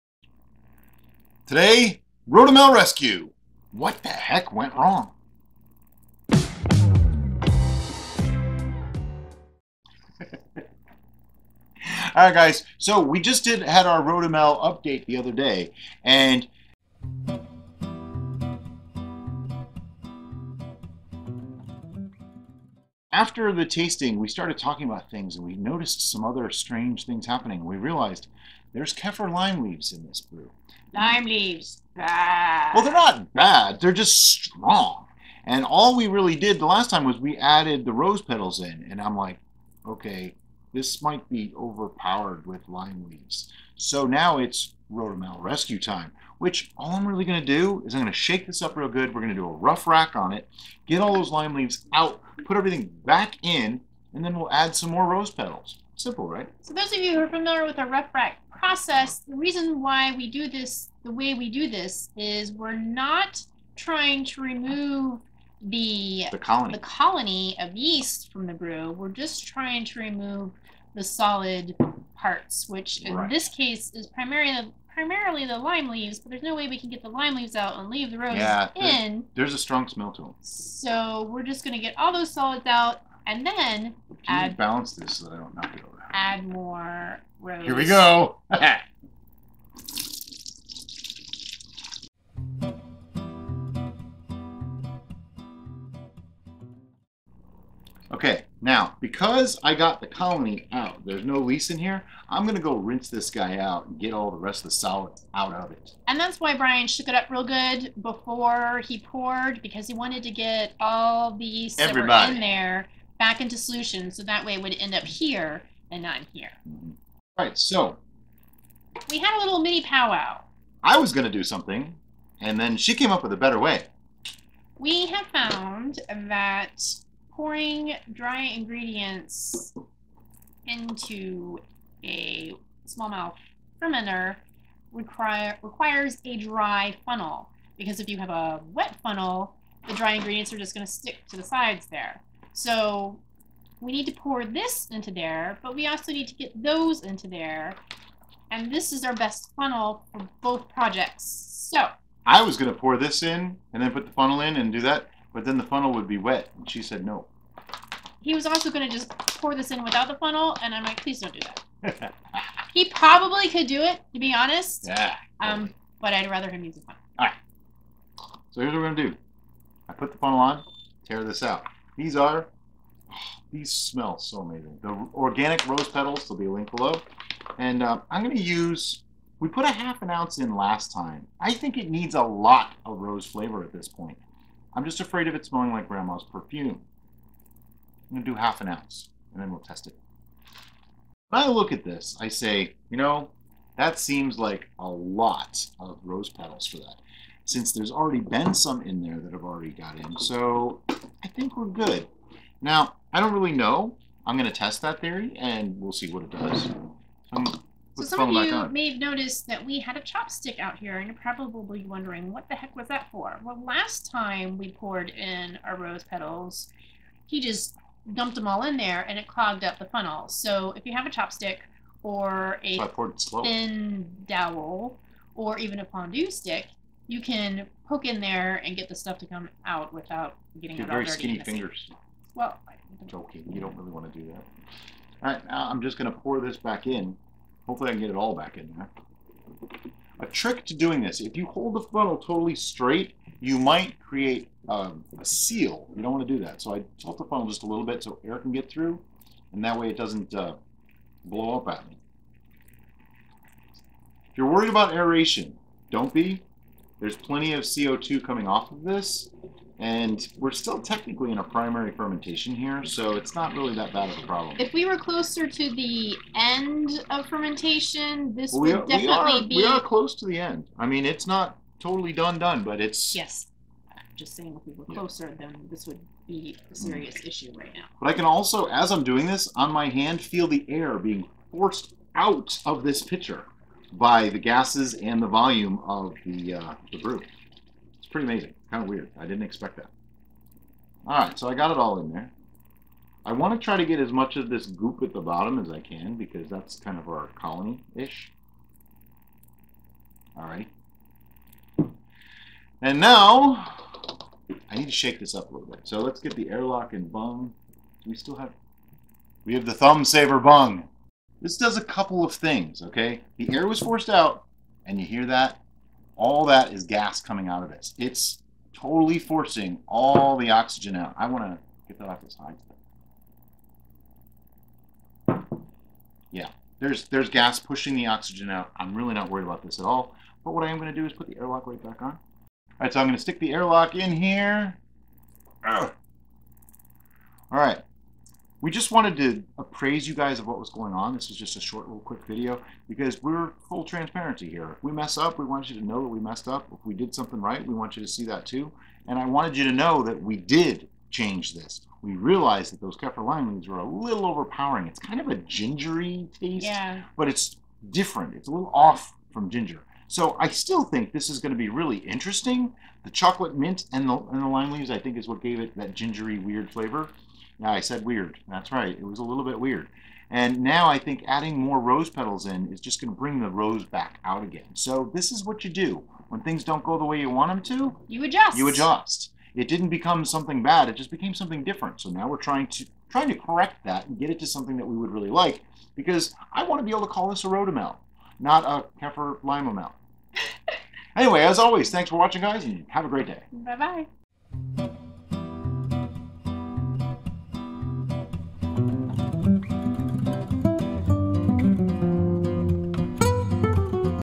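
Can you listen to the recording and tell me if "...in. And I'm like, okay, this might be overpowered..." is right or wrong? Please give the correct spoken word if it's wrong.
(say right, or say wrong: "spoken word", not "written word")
right.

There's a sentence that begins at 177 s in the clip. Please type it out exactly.
And uh, I'm gonna use, we put a half an ounce in last time.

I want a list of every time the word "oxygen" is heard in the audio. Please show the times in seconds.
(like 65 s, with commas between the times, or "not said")
320 s, 328 s.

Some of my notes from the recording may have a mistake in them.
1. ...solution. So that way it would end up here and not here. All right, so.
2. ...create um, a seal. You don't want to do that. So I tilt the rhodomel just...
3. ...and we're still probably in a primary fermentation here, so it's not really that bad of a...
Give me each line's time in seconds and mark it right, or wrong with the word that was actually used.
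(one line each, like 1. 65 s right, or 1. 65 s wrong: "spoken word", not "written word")
1. 113 s right
2. 243 s wrong: "funnel", not "rhodomel"
3. 259 s wrong: "technically", not "probably".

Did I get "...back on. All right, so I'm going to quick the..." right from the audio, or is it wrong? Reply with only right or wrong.
wrong.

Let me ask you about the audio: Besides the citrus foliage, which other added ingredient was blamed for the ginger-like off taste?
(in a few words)
Chocolate mint.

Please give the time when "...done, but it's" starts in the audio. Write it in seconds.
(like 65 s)
272 s.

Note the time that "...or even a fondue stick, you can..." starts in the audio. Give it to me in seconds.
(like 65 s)
225 s.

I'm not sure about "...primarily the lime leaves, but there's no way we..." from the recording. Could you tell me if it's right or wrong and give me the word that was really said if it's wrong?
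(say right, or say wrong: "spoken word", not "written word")
right.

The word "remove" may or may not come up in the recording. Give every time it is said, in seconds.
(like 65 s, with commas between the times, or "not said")
64 s, 69 s.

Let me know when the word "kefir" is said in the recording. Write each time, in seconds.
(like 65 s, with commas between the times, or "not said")
28 s, 352 s, 389 s.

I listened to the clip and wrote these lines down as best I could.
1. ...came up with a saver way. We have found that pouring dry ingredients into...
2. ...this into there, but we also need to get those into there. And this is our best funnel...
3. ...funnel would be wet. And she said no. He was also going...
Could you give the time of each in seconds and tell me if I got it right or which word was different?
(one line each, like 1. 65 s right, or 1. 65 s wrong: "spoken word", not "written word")
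1. 122 s wrong: "better", not "saver"
2. 144 s right
3. 155 s right.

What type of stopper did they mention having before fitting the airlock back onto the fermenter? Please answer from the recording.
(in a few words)
Thumb saver bung.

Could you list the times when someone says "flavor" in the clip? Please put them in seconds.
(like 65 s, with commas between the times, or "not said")
183 s, 366 s.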